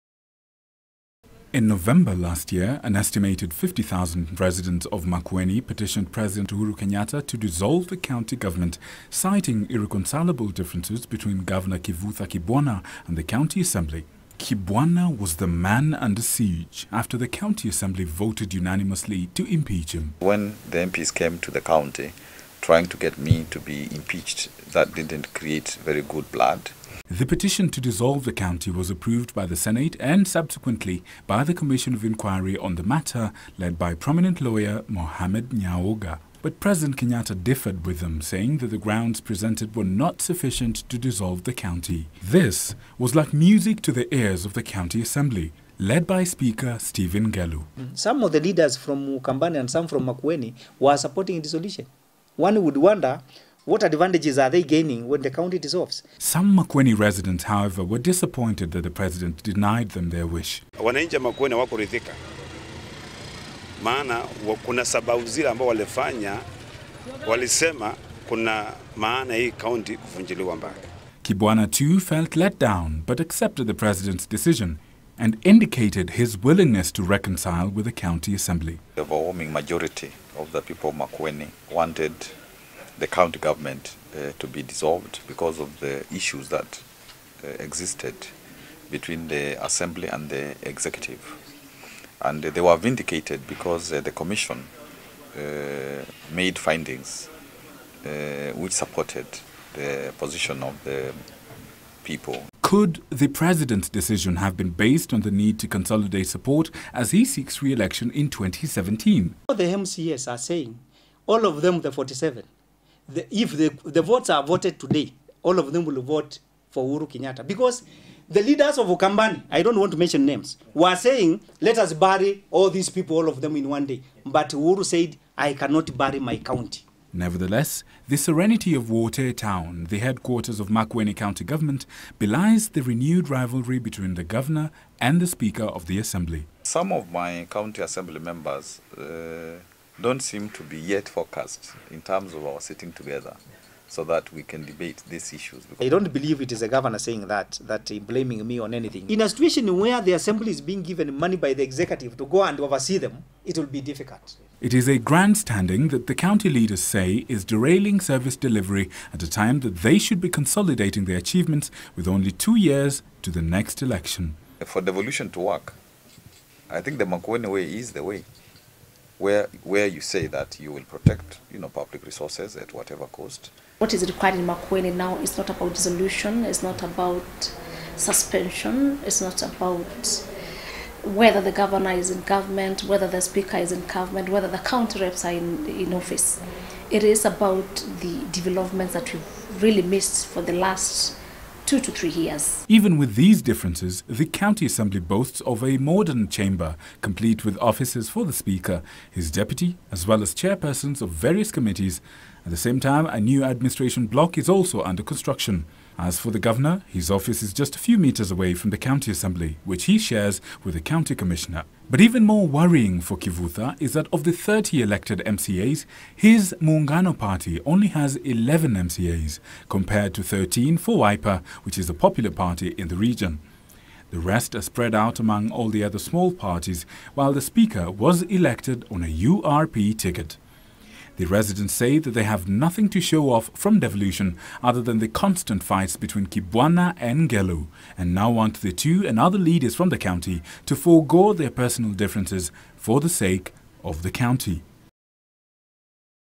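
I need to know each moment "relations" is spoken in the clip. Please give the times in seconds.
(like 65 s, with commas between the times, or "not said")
not said.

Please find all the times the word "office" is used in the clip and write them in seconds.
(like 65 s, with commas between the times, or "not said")
185 s, 197 s, 207 s.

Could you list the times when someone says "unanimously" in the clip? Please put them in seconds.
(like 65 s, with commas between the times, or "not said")
18 s.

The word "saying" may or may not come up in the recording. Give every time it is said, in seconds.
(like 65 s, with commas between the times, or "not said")
38 s, 110 s, 120 s, 146 s.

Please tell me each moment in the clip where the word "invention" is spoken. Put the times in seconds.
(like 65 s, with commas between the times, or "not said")
not said.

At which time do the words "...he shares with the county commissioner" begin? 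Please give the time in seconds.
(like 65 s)
209 s.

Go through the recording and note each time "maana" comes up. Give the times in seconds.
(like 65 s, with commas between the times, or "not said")
63 s, 68 s.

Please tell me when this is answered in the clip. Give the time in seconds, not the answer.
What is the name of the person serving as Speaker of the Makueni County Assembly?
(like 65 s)
46 s.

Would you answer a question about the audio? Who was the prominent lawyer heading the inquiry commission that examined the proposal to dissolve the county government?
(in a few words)
Mohamed Nyaoga.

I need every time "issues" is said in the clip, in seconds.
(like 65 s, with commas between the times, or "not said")
86 s, 145 s.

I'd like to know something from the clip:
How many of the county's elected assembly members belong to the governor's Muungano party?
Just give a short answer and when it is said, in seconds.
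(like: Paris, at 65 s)
11, at 218 s.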